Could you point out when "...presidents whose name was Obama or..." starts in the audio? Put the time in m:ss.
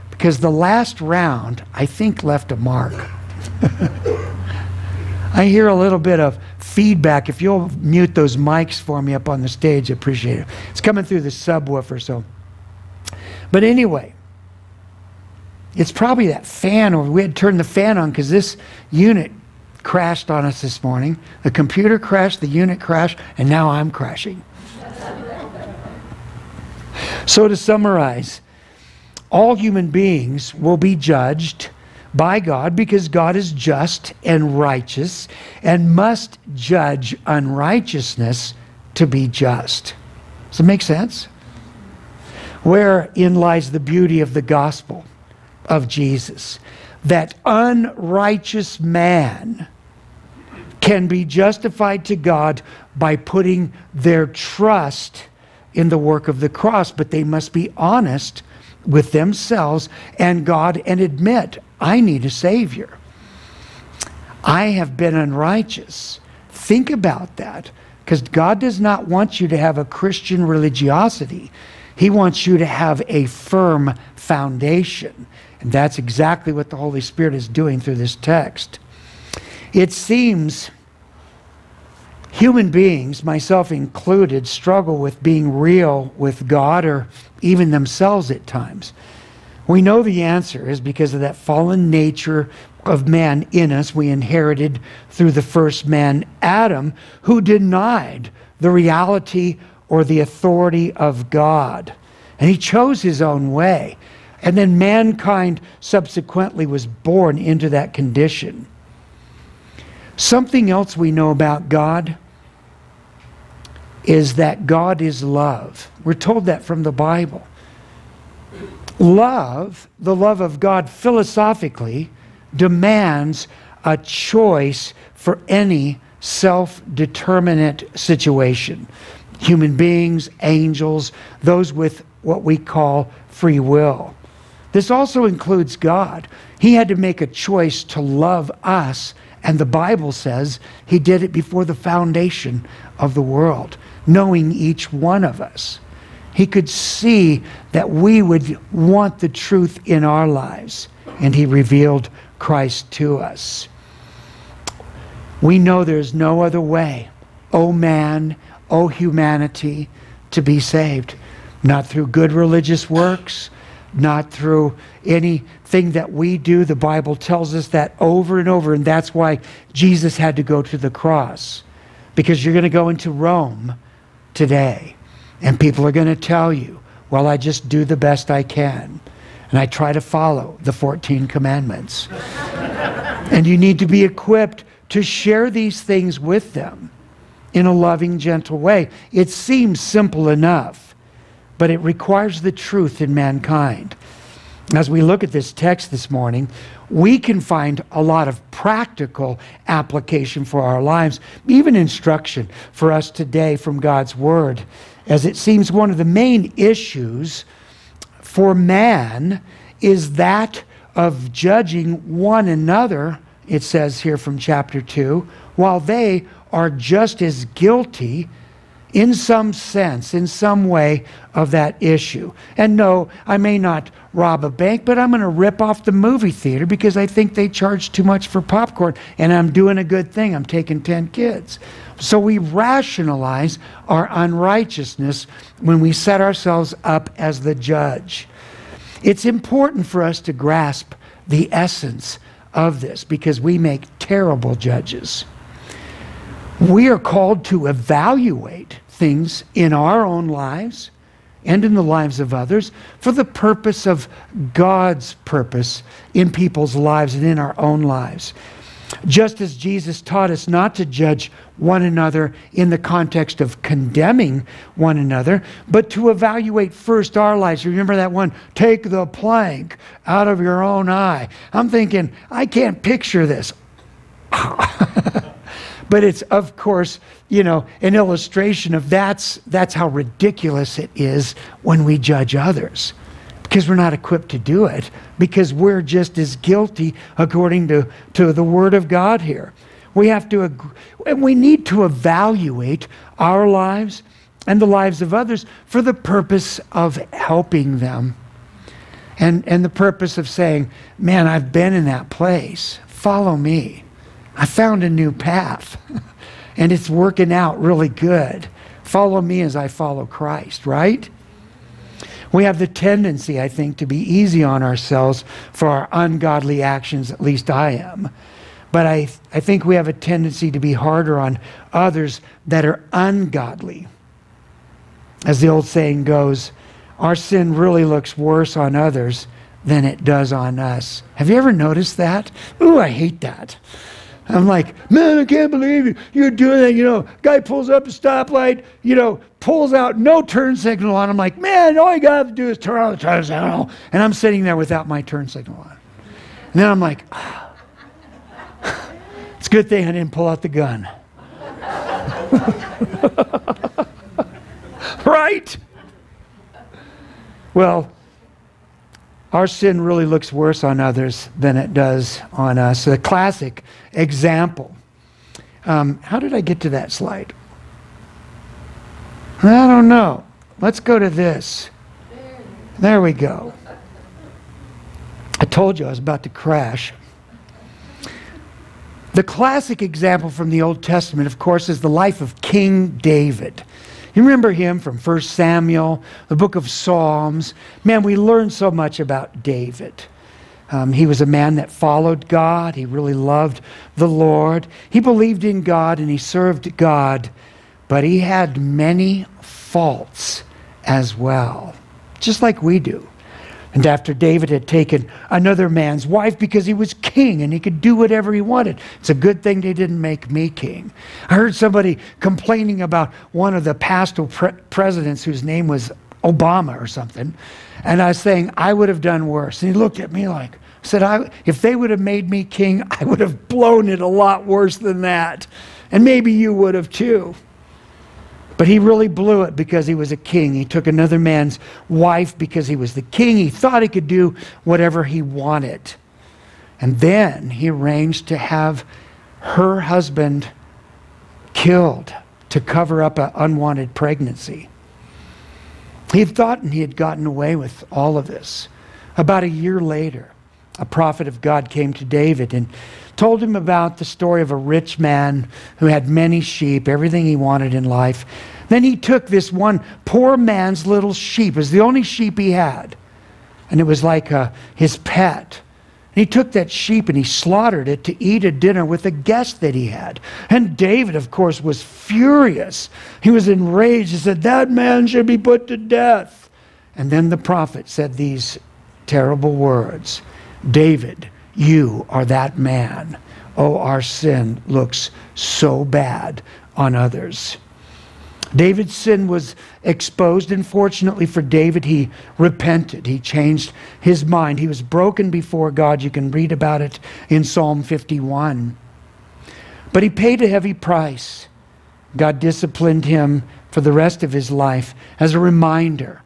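6:54.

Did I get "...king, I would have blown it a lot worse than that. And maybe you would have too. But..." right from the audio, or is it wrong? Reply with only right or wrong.
right.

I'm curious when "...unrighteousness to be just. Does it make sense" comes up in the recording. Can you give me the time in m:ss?
0:37.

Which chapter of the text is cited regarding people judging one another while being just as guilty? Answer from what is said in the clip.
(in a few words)
Chapter 2.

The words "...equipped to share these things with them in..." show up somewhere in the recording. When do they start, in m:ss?
3:04.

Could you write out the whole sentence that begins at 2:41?
Not through good religious works, not through anything that we do.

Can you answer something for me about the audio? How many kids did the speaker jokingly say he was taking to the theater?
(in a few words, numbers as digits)
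10.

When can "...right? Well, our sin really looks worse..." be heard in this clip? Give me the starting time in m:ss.
5:55.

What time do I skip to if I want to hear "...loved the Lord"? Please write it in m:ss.
6:33.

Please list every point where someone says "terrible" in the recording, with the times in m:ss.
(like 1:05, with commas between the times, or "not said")
4:03, 7:59.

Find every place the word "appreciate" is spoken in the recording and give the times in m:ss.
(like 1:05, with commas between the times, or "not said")
0:09.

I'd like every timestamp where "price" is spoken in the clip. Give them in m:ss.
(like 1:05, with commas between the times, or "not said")
8:20.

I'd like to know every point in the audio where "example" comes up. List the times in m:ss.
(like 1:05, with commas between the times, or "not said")
6:03, 6:19.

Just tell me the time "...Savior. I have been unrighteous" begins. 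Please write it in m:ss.
1:02.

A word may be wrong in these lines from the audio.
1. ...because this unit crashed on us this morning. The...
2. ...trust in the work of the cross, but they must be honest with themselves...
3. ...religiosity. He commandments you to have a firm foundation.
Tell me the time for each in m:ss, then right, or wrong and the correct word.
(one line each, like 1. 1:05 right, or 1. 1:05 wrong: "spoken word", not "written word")
1. 0:18 right
2. 0:54 right
3. 1:10 wrong: "wants", not "commandments".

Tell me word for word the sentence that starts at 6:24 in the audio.
You remember him from 1 Samuel, the book of Psalms.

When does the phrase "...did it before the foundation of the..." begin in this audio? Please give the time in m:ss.
2:20.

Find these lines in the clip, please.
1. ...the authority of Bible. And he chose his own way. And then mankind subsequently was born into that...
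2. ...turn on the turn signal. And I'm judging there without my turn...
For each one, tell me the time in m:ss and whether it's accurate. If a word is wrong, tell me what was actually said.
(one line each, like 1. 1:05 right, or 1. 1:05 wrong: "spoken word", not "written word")
1. 1:40 wrong: "God", not "Bible"
2. 5:42 wrong: "sitting", not "judging".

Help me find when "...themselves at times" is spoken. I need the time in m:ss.
1:27.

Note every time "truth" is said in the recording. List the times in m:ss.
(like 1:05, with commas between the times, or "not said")
2:29, 3:12.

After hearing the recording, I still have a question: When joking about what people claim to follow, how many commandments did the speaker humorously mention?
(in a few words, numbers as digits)
14.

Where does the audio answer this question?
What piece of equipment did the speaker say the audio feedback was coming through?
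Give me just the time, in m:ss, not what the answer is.
0:11.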